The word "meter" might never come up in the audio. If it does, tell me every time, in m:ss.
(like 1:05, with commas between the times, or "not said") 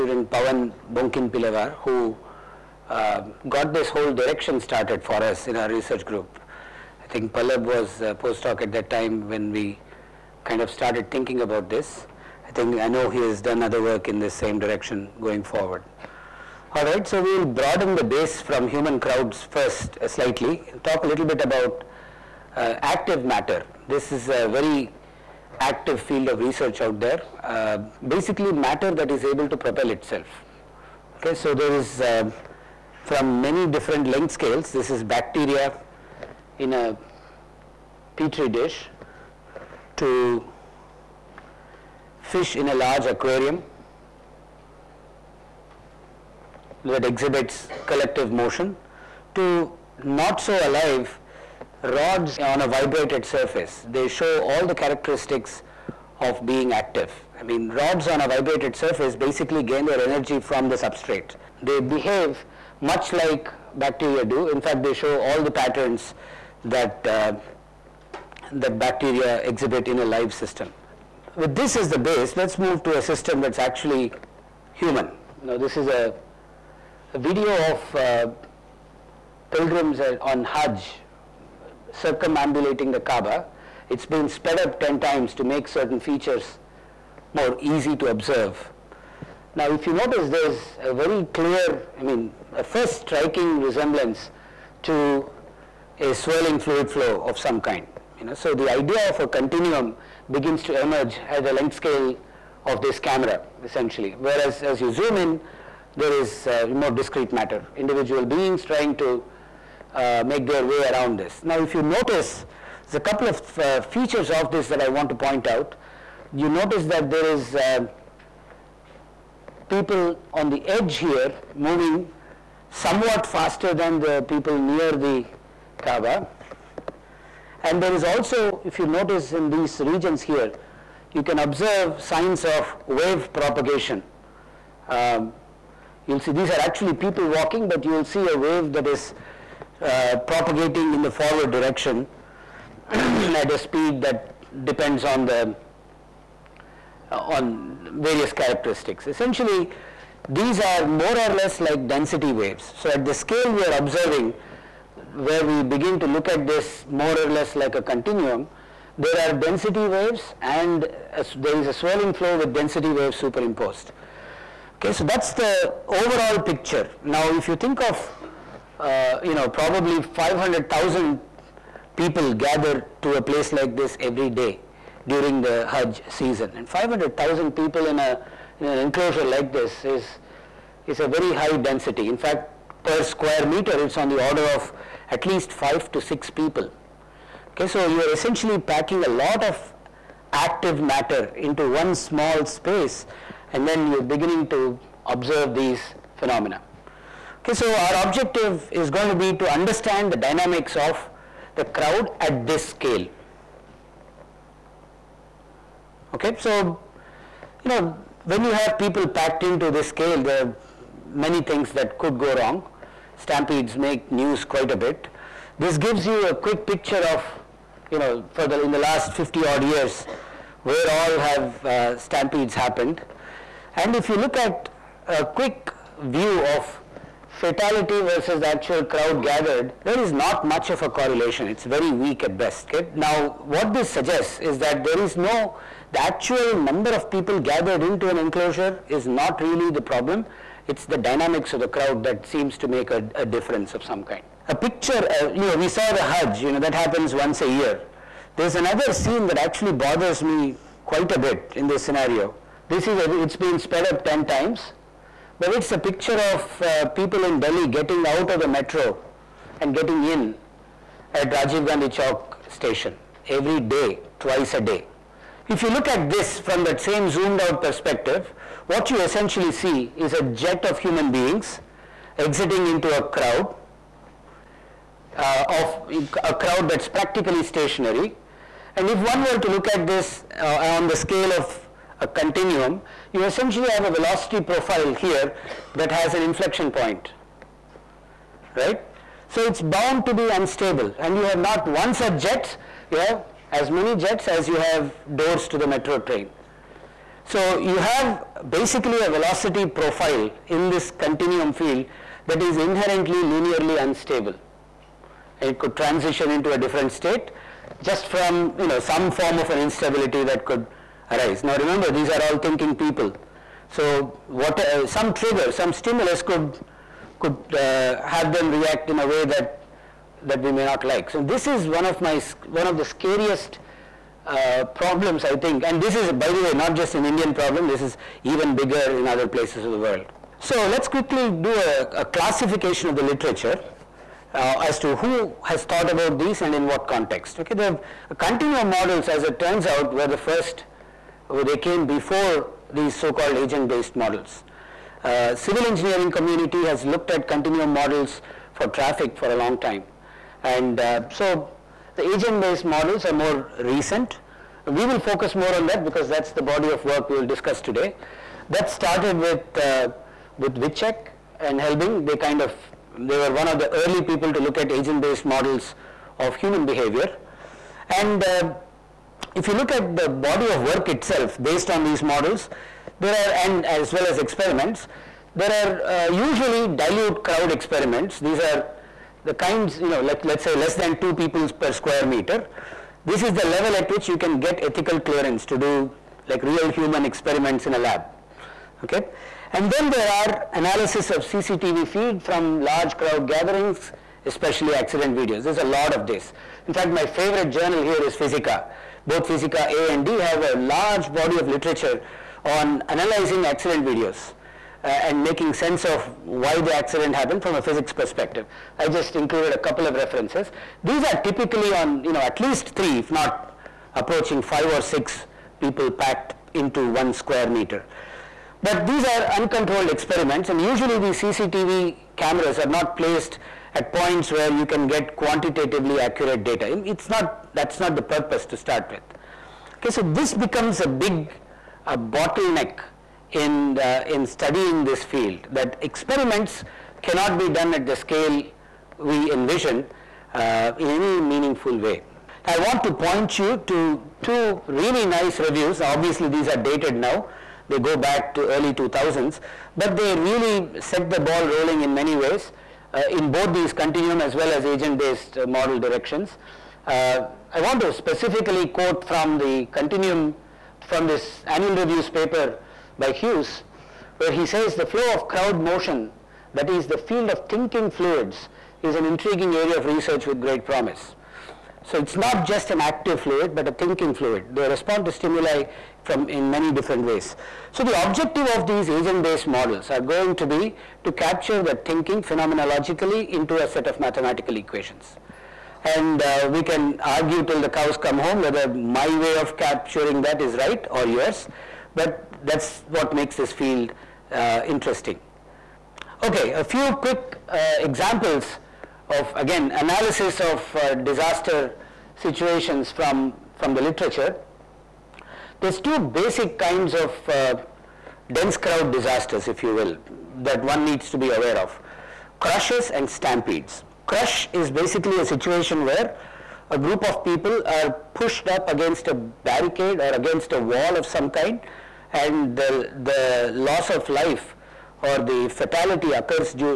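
3:03, 6:22, 6:57.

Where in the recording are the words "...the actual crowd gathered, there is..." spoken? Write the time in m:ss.
3:48.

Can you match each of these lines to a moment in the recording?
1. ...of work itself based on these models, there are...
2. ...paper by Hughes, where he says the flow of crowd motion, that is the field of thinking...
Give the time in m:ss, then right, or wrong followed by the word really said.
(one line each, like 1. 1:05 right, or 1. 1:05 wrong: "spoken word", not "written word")
1. 6:10 right
2. 7:42 right.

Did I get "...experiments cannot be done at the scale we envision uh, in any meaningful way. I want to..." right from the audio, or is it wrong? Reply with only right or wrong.
right.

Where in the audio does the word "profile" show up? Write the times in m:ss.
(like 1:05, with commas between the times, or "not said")
4:44, 4:59.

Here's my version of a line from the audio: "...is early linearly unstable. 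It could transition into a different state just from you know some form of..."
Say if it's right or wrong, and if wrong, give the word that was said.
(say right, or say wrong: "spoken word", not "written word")
wrong: "inherently", not "early".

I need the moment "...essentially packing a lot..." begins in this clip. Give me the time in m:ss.
3:08.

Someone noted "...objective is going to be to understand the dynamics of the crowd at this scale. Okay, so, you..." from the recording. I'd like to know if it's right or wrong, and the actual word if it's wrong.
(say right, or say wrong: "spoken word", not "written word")
right.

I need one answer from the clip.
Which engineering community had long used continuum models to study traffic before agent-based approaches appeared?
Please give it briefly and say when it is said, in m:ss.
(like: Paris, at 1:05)
Civil engineering, at 5:45.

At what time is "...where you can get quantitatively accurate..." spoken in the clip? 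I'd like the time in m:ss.
7:04.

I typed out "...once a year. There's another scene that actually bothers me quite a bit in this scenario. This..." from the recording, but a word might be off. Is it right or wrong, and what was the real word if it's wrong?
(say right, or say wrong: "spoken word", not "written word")
right.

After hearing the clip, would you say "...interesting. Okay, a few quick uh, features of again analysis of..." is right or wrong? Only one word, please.
wrong.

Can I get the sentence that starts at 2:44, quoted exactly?
Okay, so that is the overall picture.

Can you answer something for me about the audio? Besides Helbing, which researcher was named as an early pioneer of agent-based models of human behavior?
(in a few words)
Vicsek.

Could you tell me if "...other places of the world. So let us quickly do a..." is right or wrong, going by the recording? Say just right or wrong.
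right.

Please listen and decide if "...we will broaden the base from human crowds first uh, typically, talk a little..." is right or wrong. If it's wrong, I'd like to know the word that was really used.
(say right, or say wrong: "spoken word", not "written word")
wrong: "slightly", not "typically".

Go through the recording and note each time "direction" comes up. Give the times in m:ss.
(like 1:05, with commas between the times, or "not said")
0:04, 0:14, 2:21, 7:35.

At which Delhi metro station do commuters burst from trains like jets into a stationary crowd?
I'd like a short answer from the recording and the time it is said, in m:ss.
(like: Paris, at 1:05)
Rajiv Gandhi Chowk, at 4:21.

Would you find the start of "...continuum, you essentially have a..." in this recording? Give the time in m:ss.
4:42.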